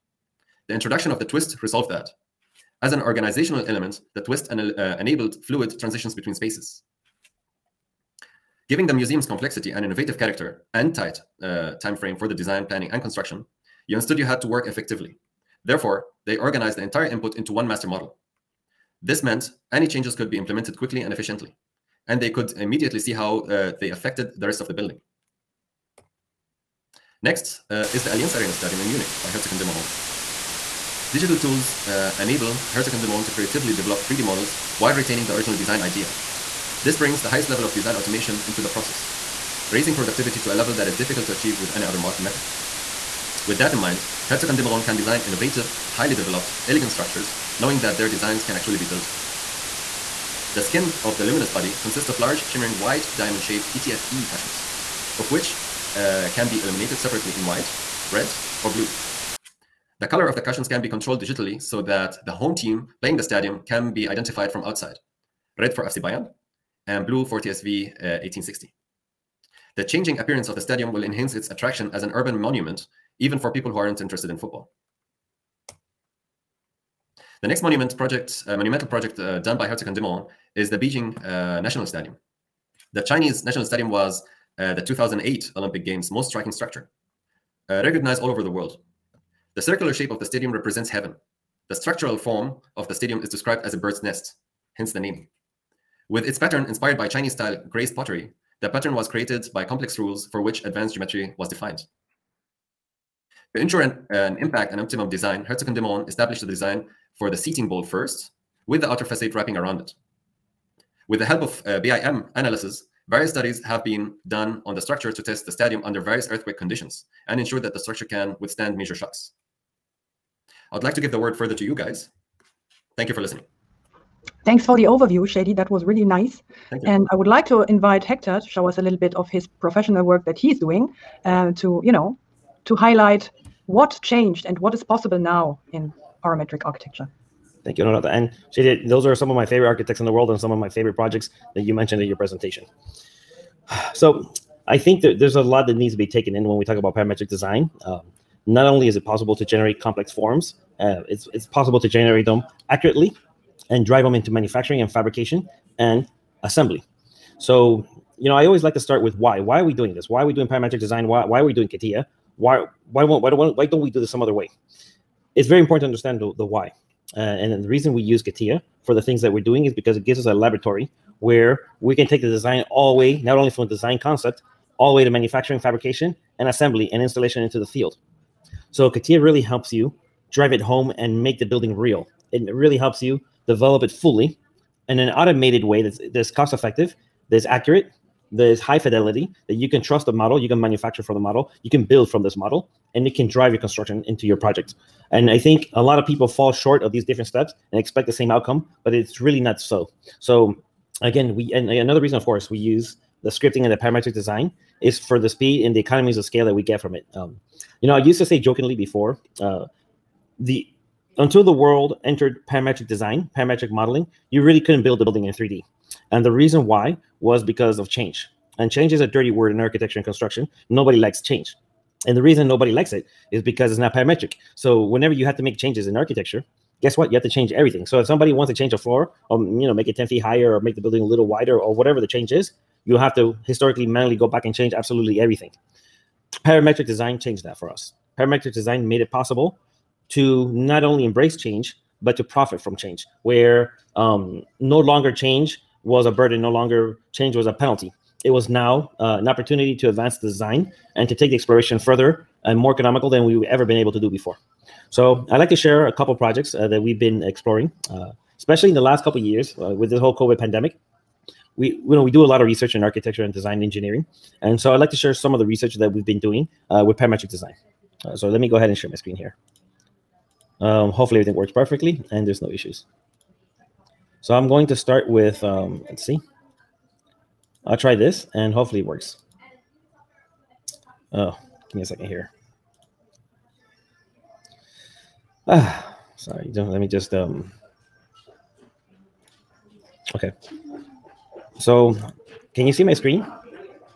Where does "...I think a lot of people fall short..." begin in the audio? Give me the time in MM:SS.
03:15.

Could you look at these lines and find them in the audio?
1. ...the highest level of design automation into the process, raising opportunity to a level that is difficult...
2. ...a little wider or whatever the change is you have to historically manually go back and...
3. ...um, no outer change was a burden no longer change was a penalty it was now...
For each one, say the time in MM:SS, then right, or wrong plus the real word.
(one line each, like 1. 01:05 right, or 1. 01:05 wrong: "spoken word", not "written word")
1. 00:37 wrong: "productivity", not "opportunity"
2. 03:51 right
3. 04:03 wrong: "longer", not "outer".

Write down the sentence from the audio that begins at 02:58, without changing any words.
So CATIA really helps you drive it home and make the building real.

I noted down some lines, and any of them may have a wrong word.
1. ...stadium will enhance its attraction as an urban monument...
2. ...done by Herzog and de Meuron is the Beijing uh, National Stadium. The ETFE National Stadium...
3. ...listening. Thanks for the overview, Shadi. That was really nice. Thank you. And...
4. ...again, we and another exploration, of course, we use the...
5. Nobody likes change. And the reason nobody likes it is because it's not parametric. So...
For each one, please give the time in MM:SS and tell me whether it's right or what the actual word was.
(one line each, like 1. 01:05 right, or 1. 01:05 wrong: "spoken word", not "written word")
1. 01:10 right
2. 01:19 wrong: "Chinese", not "ETFE"
3. 02:03 right
4. 03:21 wrong: "reason", not "exploration"
5. 03:40 right.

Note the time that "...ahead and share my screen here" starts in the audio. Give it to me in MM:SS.
04:28.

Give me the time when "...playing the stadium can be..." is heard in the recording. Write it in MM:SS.
01:03.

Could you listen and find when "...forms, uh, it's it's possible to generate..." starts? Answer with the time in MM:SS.
02:30.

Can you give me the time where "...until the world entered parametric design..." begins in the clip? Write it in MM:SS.
03:31.